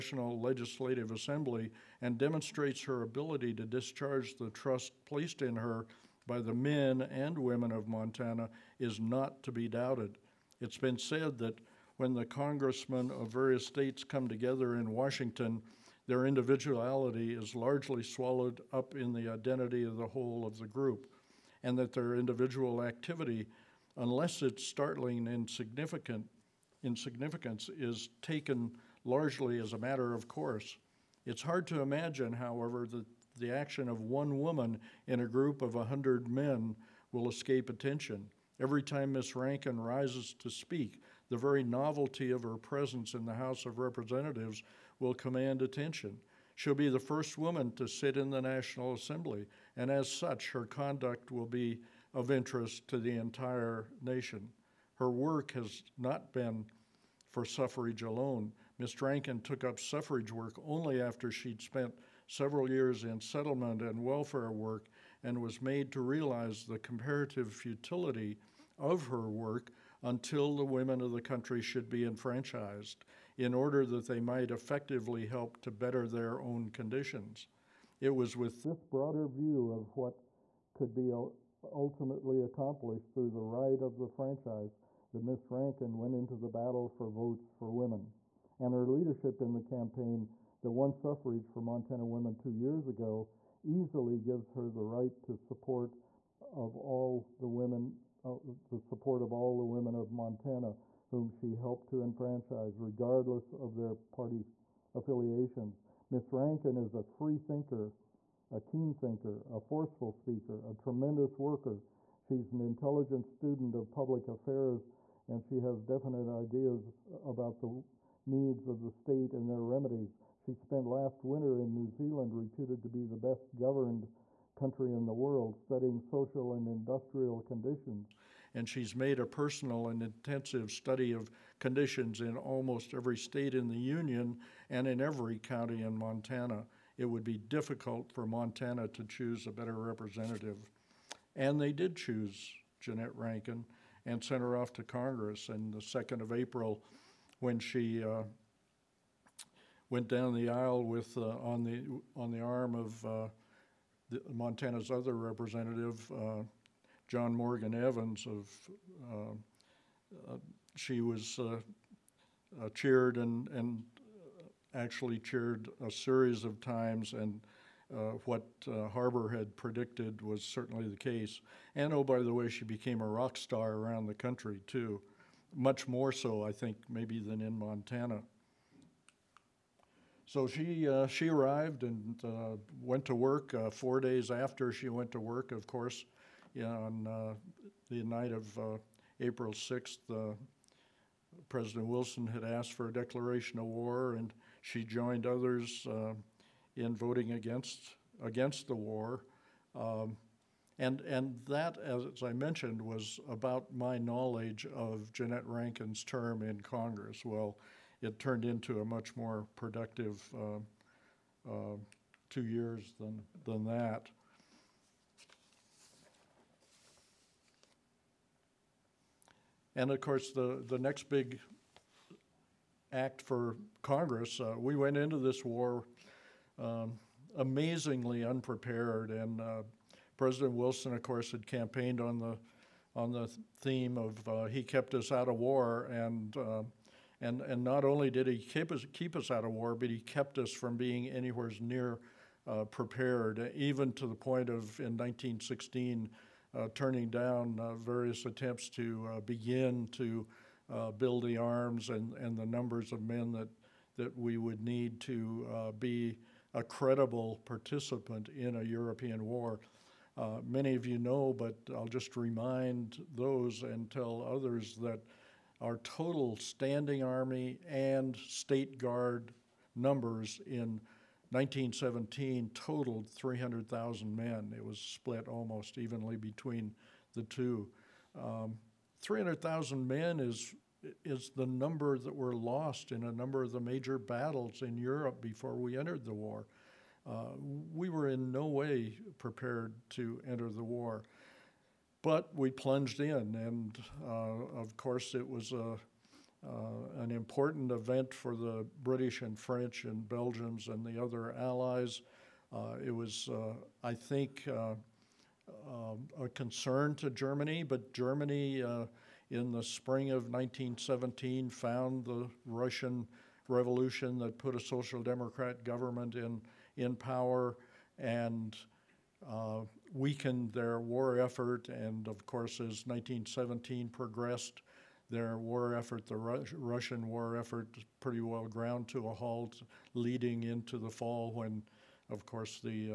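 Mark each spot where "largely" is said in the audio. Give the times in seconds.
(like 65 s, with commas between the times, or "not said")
17 s, 29 s.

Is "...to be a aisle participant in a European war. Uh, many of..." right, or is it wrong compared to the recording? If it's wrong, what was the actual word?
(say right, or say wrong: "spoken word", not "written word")
wrong: "credible", not "aisle".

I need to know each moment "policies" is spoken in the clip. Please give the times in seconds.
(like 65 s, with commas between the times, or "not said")
not said.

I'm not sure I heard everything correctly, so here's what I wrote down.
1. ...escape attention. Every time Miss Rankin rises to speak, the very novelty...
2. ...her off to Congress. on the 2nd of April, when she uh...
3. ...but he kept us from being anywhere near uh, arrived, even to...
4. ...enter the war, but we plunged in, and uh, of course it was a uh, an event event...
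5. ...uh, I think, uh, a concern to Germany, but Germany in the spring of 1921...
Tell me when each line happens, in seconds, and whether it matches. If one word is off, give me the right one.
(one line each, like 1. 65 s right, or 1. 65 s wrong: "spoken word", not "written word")
1. 37 s right
2. 144 s right
3. 239 s wrong: "prepared", not "arrived"
4. 290 s wrong: "important", not "event"
5. 303 s wrong: "1917", not "1921".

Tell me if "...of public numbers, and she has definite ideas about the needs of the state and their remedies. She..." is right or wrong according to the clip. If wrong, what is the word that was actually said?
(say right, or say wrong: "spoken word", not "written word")
wrong: "affairs", not "numbers".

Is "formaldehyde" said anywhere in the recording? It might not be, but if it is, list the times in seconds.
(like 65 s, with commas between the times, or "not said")
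not said.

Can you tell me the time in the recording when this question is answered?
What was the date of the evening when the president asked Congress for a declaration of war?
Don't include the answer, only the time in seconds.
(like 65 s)
189 s.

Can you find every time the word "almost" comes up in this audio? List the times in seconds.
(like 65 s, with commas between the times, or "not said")
132 s, 275 s.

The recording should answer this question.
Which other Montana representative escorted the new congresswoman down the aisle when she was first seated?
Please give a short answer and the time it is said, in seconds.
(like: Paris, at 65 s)
John Morgan Evans, at 157 s.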